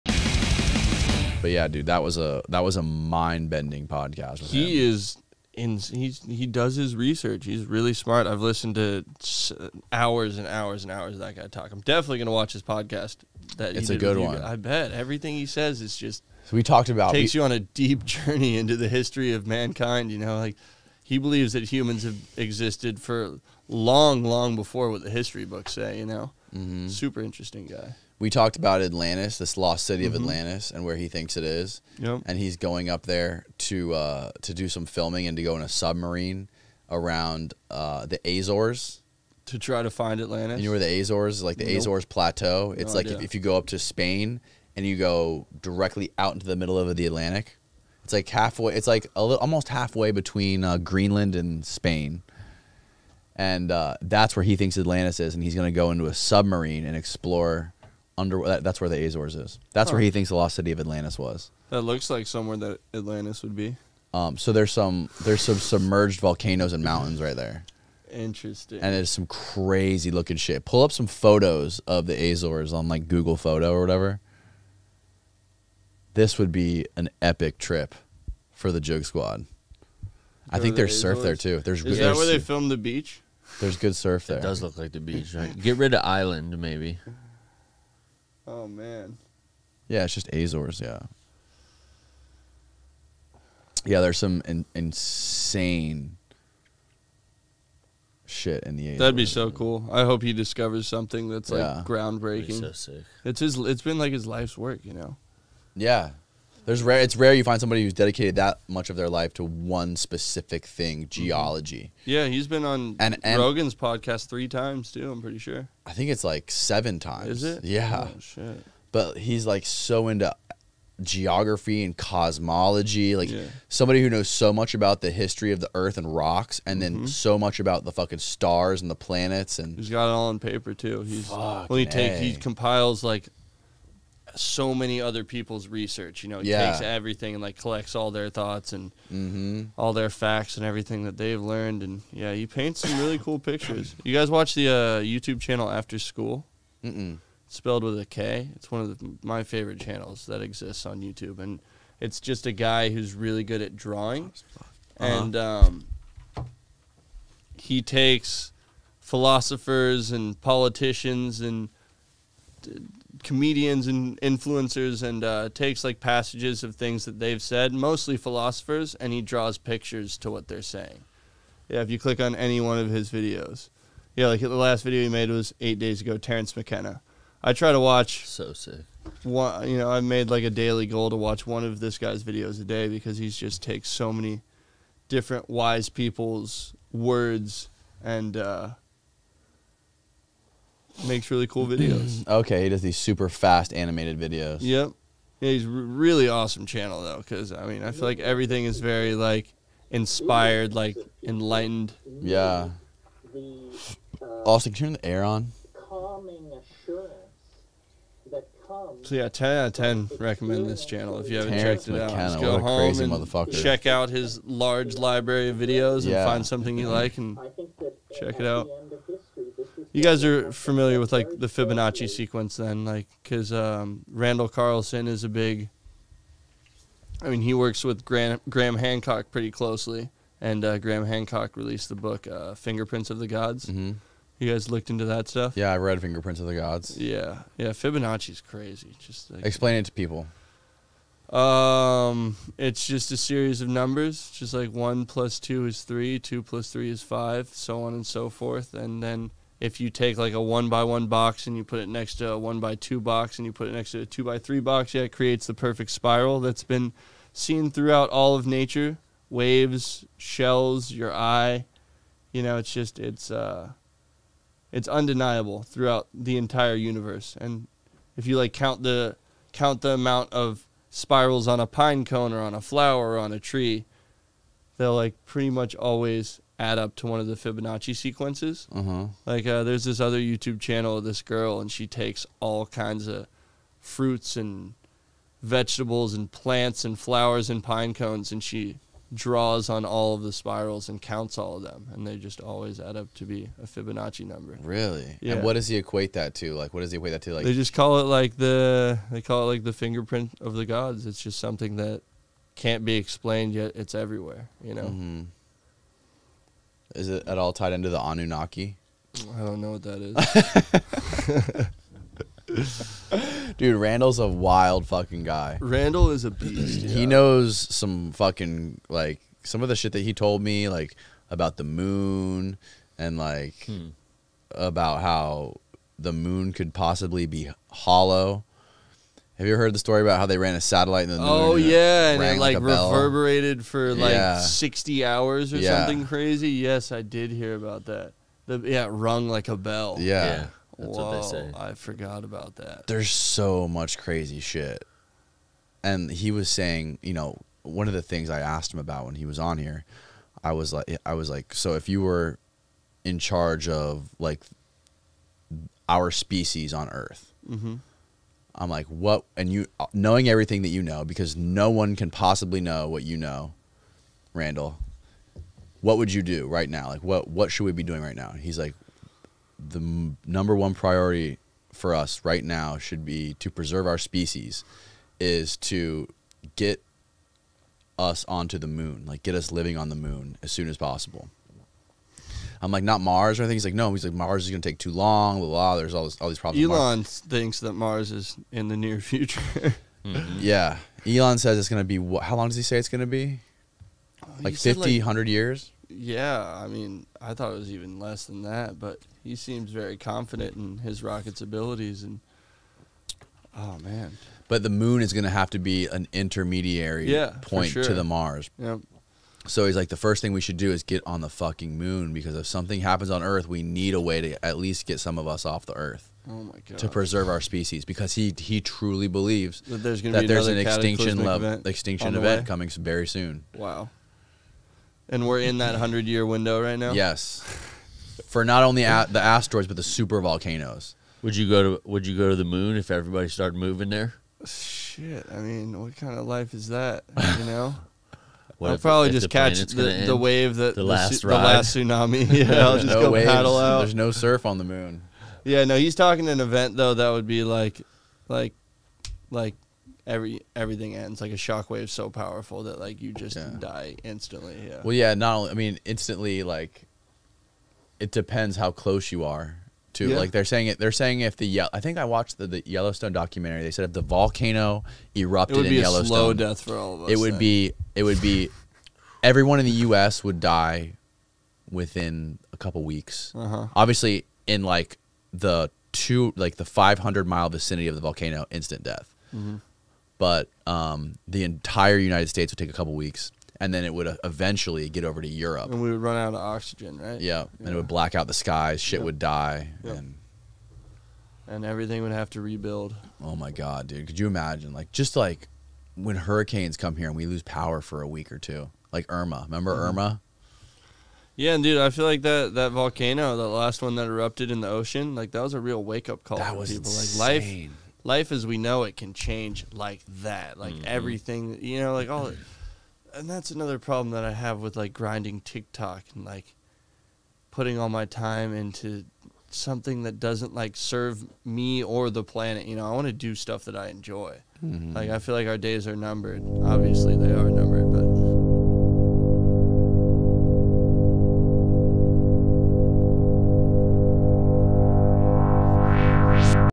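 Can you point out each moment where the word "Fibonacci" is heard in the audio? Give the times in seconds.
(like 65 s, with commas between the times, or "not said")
221 s, 237 s, 277 s, 293 s.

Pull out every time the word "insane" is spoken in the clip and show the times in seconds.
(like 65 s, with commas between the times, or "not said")
94 s, 506 s.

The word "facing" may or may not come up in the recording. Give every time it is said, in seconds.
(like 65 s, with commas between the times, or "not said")
not said.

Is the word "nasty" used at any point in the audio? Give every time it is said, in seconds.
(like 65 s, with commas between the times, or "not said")
not said.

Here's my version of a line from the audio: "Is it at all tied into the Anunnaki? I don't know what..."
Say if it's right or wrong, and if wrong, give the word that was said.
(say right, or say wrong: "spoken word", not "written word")
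right.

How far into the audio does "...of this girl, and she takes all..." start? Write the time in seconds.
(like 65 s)
280 s.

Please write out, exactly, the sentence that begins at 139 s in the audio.
all their facts and everything that they've learned.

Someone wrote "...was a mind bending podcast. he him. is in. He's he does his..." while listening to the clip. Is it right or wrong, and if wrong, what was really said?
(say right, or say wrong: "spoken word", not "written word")
right.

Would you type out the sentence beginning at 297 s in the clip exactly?
Like, they just call it like the they call it like the fingerprint of the gods.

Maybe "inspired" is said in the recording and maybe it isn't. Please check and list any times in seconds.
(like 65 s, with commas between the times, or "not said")
199 s.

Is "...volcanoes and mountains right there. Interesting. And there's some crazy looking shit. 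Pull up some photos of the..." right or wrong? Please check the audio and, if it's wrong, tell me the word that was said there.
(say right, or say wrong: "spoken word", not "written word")
right.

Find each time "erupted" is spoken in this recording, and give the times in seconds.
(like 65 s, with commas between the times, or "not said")
465 s, 504 s.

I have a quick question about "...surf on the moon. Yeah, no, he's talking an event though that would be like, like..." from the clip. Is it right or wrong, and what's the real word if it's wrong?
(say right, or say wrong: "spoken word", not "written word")
right.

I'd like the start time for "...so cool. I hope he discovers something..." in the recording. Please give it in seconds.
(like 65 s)
99 s.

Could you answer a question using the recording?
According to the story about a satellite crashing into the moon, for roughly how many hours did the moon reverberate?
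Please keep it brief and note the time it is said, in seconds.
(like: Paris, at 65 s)
60, at 334 s.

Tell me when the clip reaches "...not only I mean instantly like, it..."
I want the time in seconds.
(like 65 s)
455 s.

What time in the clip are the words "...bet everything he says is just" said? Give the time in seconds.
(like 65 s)
14 s.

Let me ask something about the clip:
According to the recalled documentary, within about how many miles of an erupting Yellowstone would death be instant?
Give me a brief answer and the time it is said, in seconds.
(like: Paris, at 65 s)
500, at 476 s.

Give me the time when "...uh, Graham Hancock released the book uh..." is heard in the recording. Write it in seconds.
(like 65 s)
230 s.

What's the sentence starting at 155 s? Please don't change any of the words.
and um, he takes philosophers and politicians and.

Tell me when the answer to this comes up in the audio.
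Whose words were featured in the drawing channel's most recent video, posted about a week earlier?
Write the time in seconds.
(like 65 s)
176 s.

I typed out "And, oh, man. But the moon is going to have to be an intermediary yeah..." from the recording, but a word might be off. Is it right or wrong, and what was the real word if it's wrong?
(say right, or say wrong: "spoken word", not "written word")
right.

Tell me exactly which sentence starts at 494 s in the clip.
Like just like when hurricanes come here and we lose power for a week or two, like Irma.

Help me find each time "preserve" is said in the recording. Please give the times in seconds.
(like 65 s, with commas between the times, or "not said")
373 s, 416 s.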